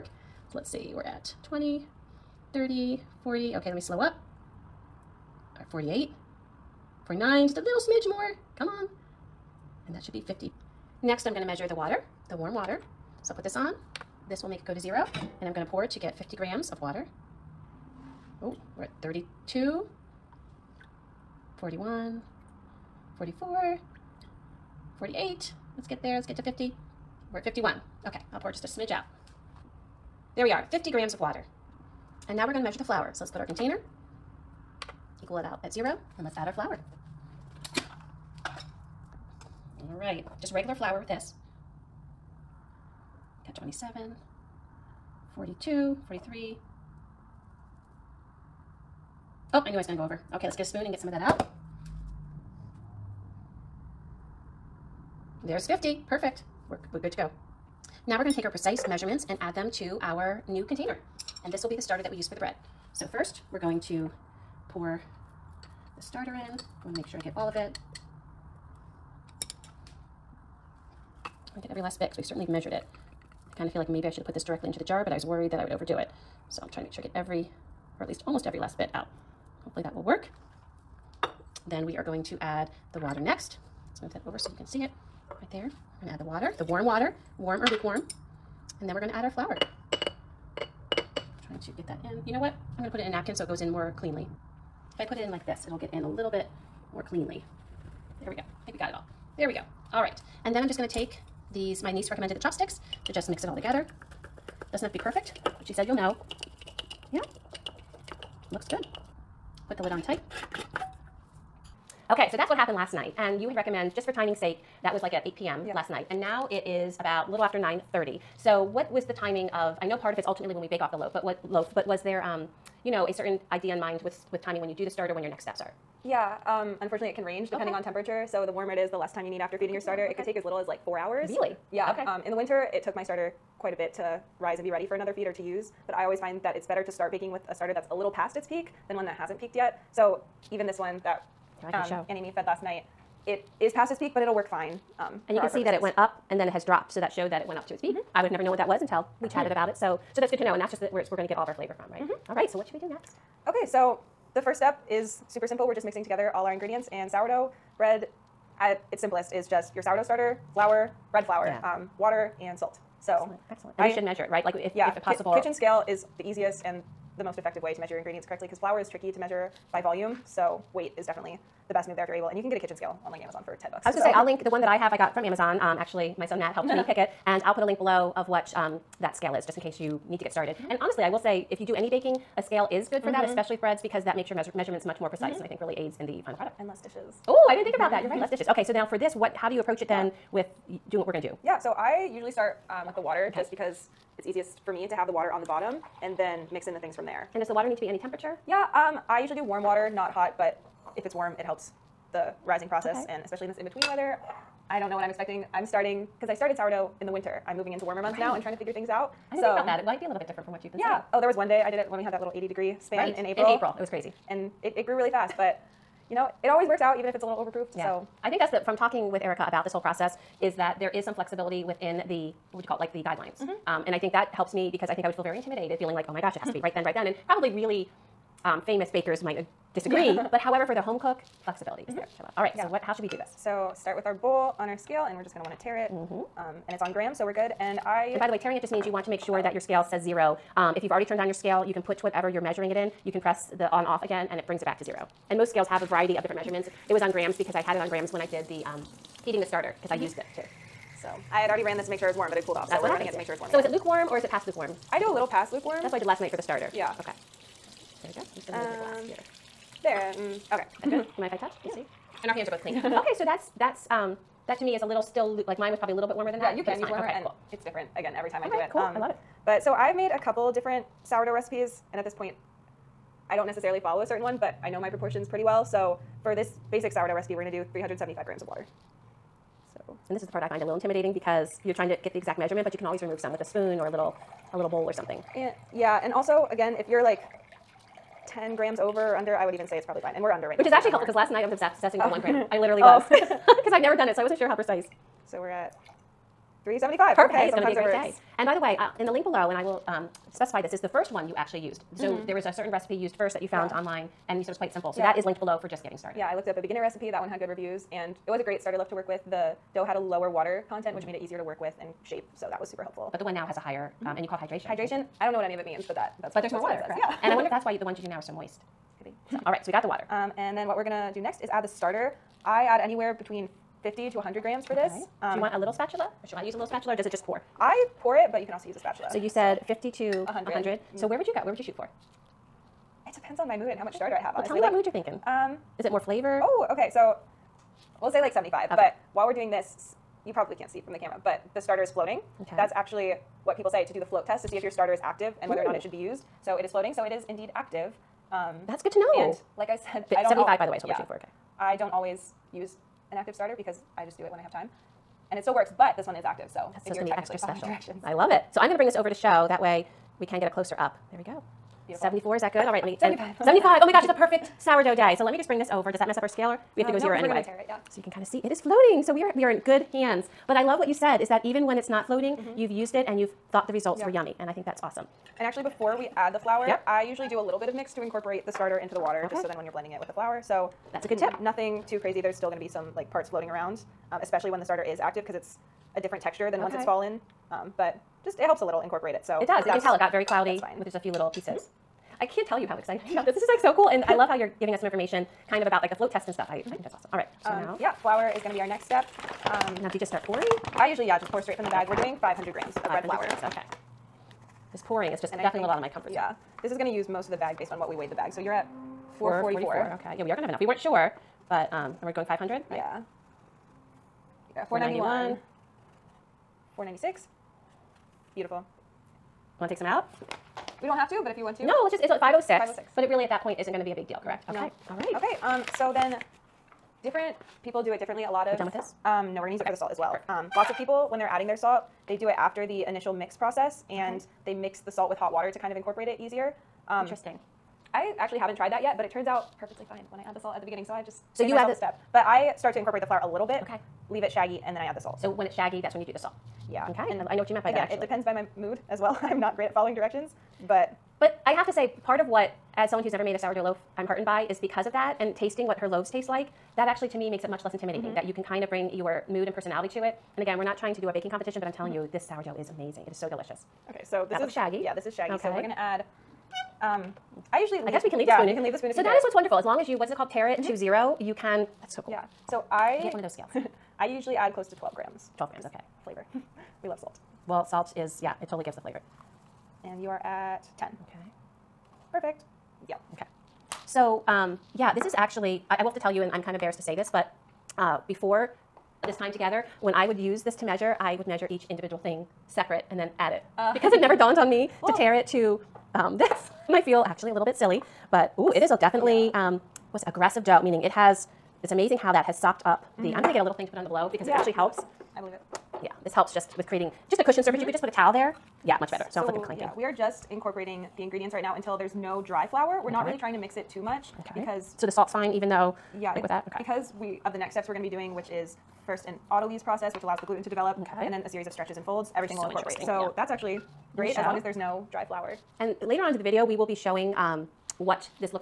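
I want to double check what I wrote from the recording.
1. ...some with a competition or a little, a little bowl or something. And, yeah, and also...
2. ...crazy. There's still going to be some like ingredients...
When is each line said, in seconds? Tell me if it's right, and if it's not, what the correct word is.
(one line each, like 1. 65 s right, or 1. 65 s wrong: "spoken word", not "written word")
1. 283 s wrong: "spoon", not "competition"
2. 381 s wrong: "parts", not "ingredients".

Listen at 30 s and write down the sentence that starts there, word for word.
There we are, 50 grams of water.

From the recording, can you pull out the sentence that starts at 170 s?
So weight is definitely the best move there if you're able.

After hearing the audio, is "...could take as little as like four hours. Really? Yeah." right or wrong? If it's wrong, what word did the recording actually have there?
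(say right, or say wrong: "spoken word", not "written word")
right.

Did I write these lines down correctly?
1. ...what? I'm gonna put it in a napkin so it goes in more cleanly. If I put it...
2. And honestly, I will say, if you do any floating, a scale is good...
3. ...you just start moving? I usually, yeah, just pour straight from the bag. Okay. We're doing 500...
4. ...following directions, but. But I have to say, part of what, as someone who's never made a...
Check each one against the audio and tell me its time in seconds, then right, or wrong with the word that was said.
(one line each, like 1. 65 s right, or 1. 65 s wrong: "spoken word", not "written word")
1. 92 s right
2. 180 s wrong: "baking", not "floating"
3. 399 s wrong: "pouring", not "moving"
4. 449 s right.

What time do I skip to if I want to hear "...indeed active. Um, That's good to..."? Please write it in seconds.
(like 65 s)
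347 s.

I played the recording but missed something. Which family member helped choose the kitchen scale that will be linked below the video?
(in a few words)
Matt.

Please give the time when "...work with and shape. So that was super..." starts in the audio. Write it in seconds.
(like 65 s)
311 s.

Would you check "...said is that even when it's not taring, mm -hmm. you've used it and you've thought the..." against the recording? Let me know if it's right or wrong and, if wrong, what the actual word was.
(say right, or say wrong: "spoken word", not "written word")
wrong: "floating", not "taring".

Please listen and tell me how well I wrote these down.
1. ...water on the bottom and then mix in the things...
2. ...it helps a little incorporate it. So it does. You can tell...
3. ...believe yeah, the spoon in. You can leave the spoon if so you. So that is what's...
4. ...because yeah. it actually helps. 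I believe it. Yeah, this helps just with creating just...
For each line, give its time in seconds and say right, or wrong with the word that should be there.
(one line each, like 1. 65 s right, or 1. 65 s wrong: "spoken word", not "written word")
1. 195 s right
2. 388 s right
3. 468 s wrong: "leave", not "believe"
4. 504 s right.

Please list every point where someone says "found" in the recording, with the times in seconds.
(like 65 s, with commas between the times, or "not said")
303 s.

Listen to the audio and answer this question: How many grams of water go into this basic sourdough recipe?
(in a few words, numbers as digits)
375.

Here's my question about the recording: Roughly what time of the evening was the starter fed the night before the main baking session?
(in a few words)
8 p.m.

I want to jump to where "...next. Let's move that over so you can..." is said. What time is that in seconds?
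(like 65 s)
83 s.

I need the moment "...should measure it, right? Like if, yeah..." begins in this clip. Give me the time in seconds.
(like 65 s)
163 s.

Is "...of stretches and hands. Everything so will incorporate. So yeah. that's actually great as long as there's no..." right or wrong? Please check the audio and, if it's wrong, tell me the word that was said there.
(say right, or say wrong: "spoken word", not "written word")
wrong: "folds", not "hands".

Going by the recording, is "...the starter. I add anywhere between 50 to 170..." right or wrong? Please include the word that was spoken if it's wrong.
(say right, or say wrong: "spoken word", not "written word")
wrong: "100", not "170".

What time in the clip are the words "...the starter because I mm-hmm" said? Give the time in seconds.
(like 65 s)
249 s.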